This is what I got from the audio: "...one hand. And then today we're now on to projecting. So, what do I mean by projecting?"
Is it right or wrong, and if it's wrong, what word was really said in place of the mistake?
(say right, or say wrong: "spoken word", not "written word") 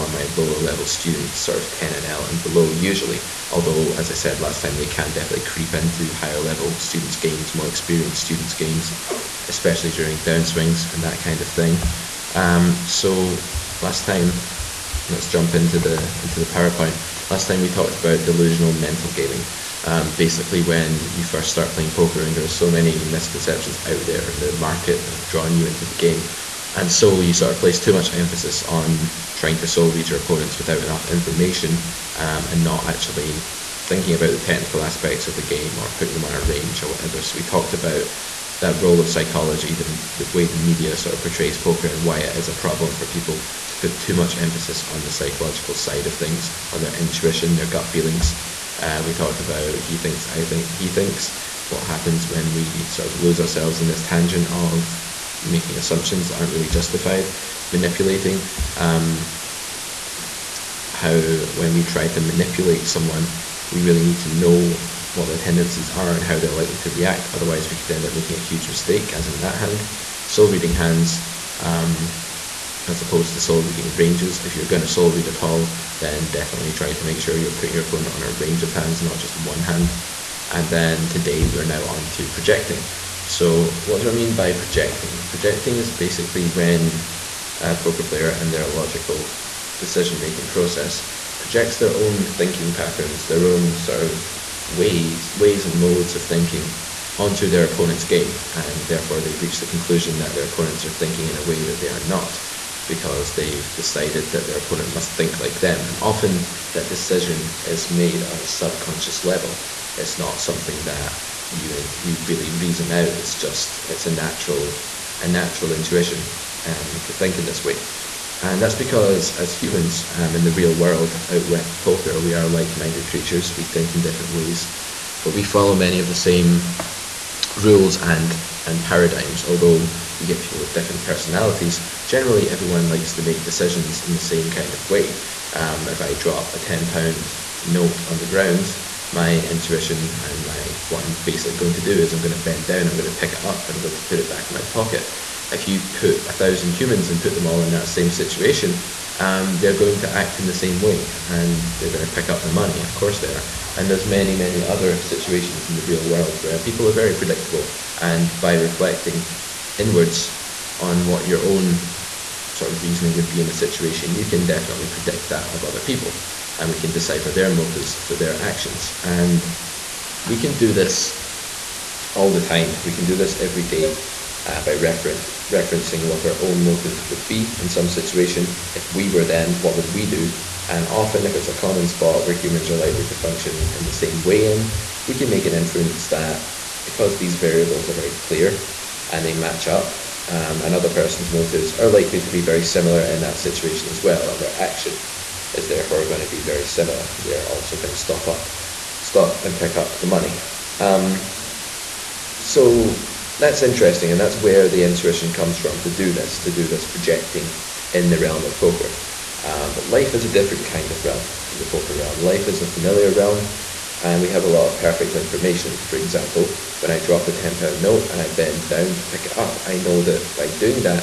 right.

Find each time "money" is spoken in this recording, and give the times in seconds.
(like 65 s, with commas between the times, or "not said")
152 s, 200 s.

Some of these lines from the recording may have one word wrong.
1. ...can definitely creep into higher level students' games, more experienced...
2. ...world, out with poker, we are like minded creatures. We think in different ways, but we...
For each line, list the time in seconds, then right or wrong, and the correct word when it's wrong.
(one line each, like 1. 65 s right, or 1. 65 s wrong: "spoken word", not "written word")
1. 4 s right
2. 120 s right.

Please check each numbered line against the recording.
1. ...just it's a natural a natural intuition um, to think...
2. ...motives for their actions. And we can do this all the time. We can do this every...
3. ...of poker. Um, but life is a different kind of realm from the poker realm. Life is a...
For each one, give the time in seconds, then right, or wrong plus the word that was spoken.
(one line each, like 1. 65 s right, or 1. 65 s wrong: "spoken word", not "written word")
1. 113 s right
2. 167 s right
3. 208 s right.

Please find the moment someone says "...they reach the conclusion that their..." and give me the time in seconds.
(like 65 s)
99 s.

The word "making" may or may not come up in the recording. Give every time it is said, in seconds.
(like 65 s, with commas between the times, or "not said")
55 s, 68 s, 90 s.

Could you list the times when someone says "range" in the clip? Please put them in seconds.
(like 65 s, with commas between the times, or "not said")
36 s, 73 s, 78 s.